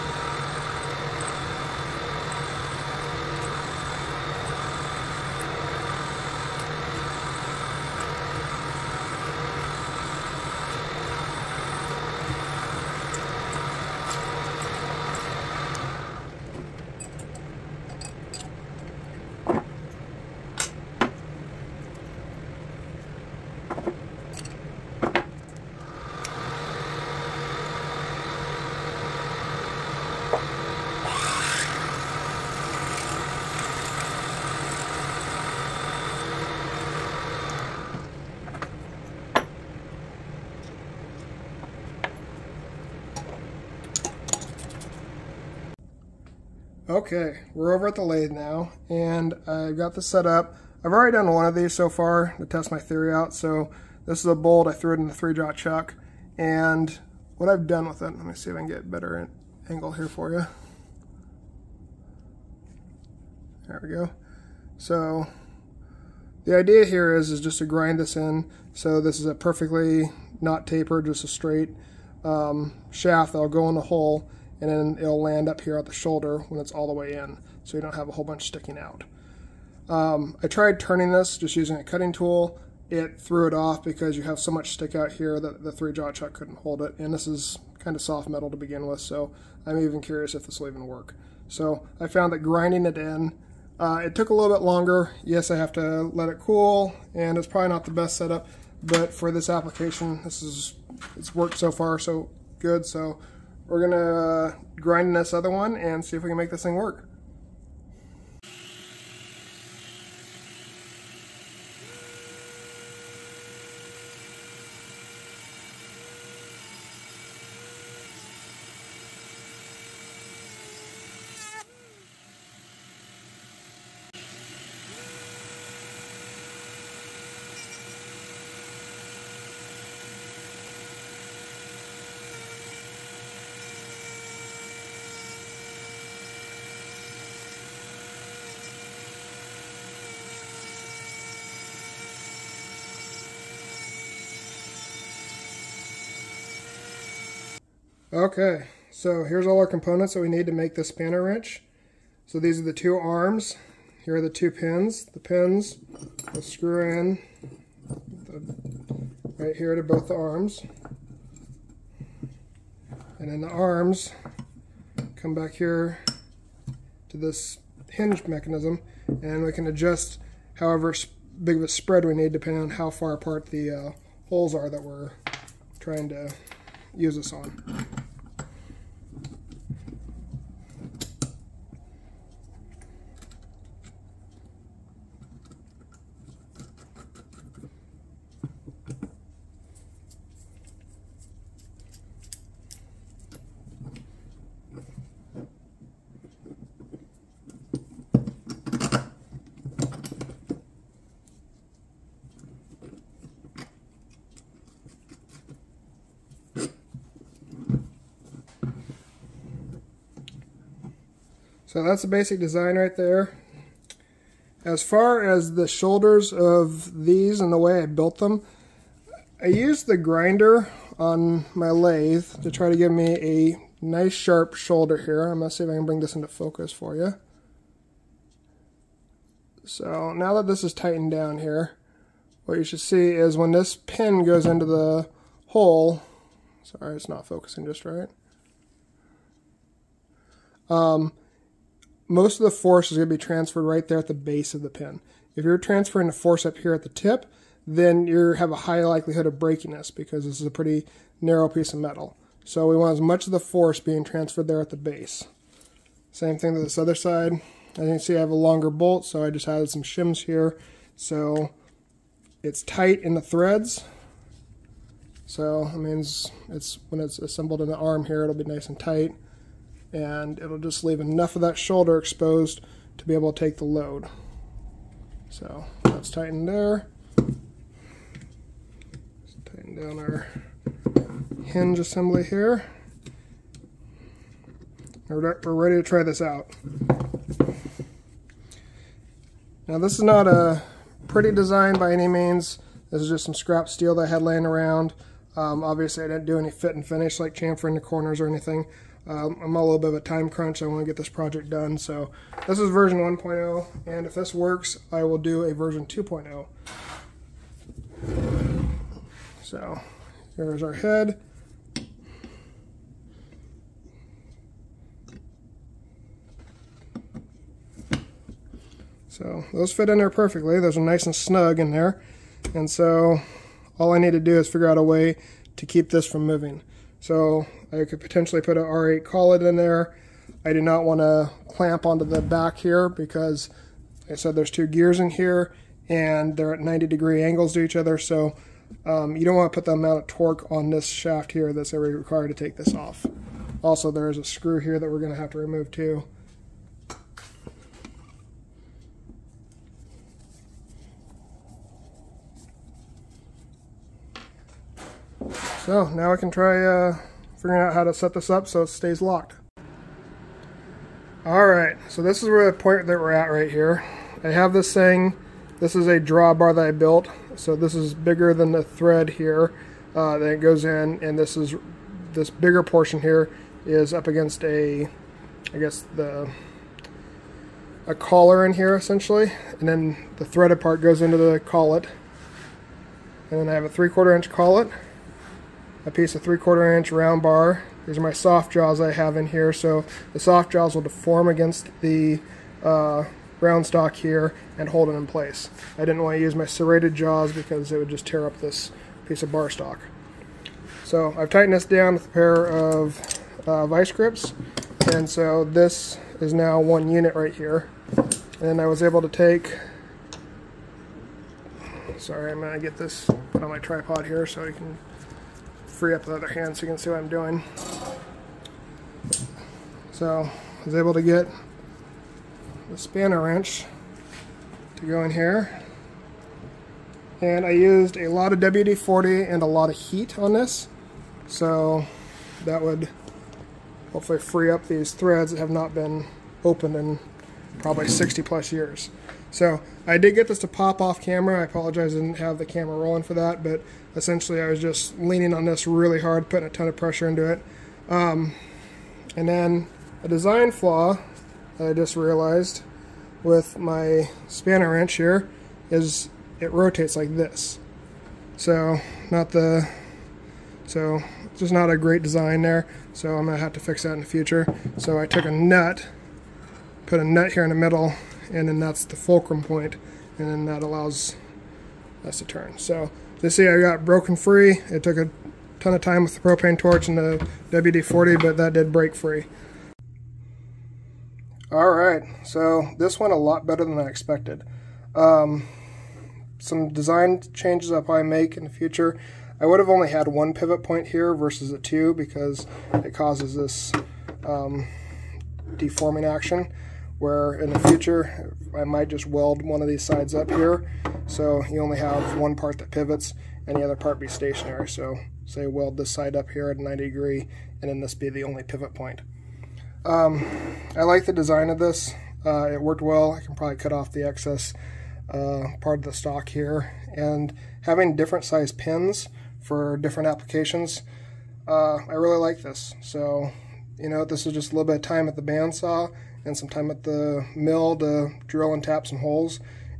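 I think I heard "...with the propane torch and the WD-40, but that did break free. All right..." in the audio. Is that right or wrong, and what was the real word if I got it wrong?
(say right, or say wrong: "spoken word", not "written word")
right.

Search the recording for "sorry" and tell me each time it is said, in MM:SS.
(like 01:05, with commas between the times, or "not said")
03:56, 06:51.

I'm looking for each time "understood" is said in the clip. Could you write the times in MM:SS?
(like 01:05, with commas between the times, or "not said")
not said.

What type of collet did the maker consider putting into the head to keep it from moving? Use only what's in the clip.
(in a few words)
R8 collet.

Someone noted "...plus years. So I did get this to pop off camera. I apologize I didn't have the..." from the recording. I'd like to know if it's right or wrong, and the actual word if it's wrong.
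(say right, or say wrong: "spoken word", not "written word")
right.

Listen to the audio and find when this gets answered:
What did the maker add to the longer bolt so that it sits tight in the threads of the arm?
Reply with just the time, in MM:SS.
04:19.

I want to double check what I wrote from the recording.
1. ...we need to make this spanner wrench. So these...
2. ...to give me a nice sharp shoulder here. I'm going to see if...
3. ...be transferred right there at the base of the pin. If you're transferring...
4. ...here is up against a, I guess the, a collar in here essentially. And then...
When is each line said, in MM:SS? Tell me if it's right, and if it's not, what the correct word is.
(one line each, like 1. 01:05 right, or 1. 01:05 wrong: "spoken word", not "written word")
1. 02:30 right
2. 03:42 right
3. 04:03 right
4. 06:13 right.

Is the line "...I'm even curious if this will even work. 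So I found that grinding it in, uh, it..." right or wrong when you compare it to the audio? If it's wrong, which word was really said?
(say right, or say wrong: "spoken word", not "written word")
right.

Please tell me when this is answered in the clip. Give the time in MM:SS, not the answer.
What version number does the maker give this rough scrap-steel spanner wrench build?
05:02.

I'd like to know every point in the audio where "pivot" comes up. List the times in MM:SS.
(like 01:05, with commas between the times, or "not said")
08:10, 08:22, 08:28.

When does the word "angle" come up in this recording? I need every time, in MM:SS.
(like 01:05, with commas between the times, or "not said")
00:59, 05:37.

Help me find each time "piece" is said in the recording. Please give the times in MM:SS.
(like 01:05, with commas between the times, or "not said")
04:11, 06:25, 06:39.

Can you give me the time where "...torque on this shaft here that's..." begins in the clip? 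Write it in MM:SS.
05:40.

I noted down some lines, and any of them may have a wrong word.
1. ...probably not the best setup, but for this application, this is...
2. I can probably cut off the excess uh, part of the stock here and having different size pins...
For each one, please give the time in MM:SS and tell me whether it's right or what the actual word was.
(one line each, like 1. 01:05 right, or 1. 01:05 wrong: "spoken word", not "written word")
1. 01:37 right
2. 08:33 right.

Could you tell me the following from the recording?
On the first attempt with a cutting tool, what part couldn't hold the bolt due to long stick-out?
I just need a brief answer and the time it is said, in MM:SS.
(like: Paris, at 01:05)
three jaw chuck, at 01:25.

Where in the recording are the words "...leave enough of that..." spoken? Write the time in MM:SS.
04:30.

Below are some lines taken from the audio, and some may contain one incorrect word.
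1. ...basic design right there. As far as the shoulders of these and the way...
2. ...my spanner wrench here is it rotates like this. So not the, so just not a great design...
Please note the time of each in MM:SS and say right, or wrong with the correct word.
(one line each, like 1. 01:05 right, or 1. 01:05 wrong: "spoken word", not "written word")
1. 03:32 right
2. 07:33 right.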